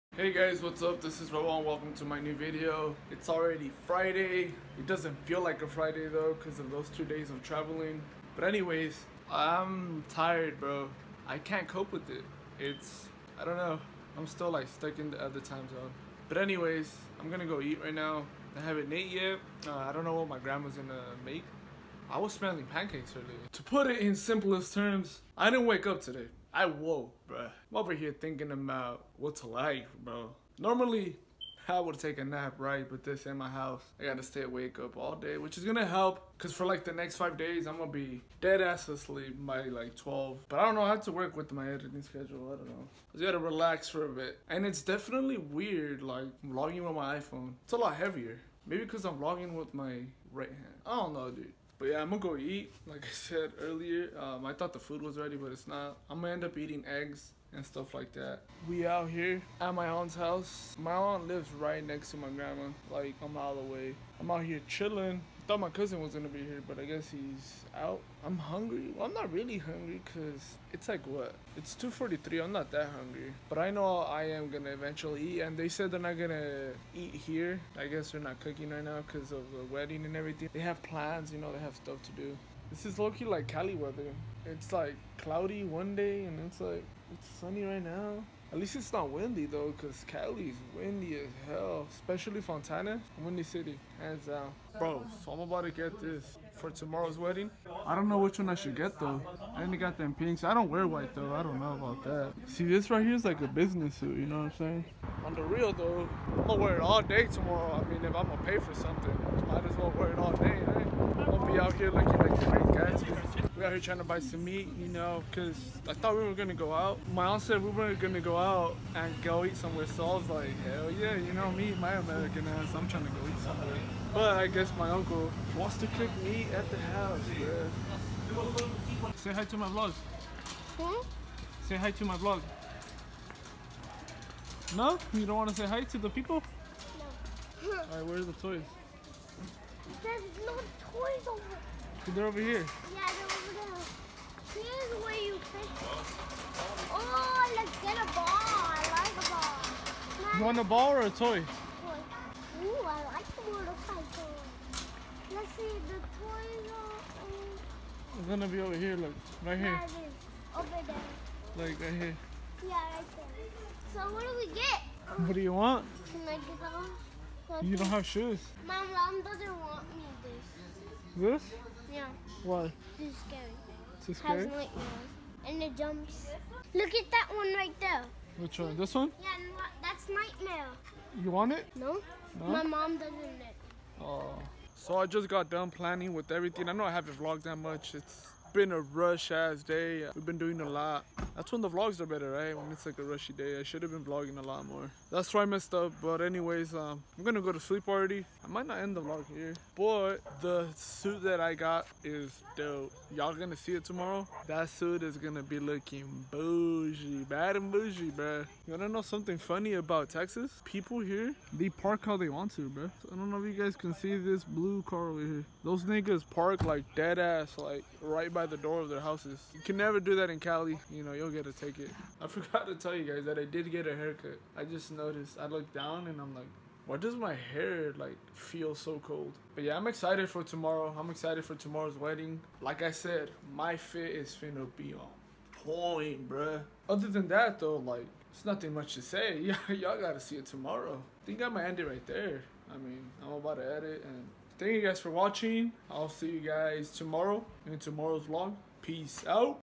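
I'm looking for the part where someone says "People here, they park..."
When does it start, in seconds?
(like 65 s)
210 s.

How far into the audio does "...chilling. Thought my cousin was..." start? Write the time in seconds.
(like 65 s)
64 s.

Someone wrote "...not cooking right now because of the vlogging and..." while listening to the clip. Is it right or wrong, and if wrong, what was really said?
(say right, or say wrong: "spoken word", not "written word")
wrong: "wedding", not "vlogging".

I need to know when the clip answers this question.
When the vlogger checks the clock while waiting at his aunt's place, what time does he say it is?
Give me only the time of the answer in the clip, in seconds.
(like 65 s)
71 s.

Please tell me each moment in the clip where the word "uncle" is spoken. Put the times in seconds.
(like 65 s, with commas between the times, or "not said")
124 s.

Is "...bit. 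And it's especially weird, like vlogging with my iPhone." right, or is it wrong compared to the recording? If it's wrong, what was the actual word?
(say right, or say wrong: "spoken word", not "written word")
wrong: "definitely", not "especially".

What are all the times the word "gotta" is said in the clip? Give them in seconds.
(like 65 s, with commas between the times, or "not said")
34 s, 43 s, 240 s.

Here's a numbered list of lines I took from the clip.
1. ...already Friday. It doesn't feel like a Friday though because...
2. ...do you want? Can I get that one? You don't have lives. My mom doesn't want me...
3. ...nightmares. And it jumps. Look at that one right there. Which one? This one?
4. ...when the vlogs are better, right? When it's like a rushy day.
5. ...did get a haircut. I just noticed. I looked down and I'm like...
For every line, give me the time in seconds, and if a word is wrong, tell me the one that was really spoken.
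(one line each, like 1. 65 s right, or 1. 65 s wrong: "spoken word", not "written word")
1. 3 s right
2. 165 s wrong: "shoes", not "lives"
3. 174 s right
4. 191 s right
5. 223 s right.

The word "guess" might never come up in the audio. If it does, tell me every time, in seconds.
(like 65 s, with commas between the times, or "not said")
66 s, 77 s, 124 s.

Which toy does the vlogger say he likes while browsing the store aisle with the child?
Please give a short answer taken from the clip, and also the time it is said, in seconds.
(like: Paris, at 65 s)
The motorcycle, at 153 s.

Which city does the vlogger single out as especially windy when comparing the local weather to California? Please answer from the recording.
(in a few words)
Fontana.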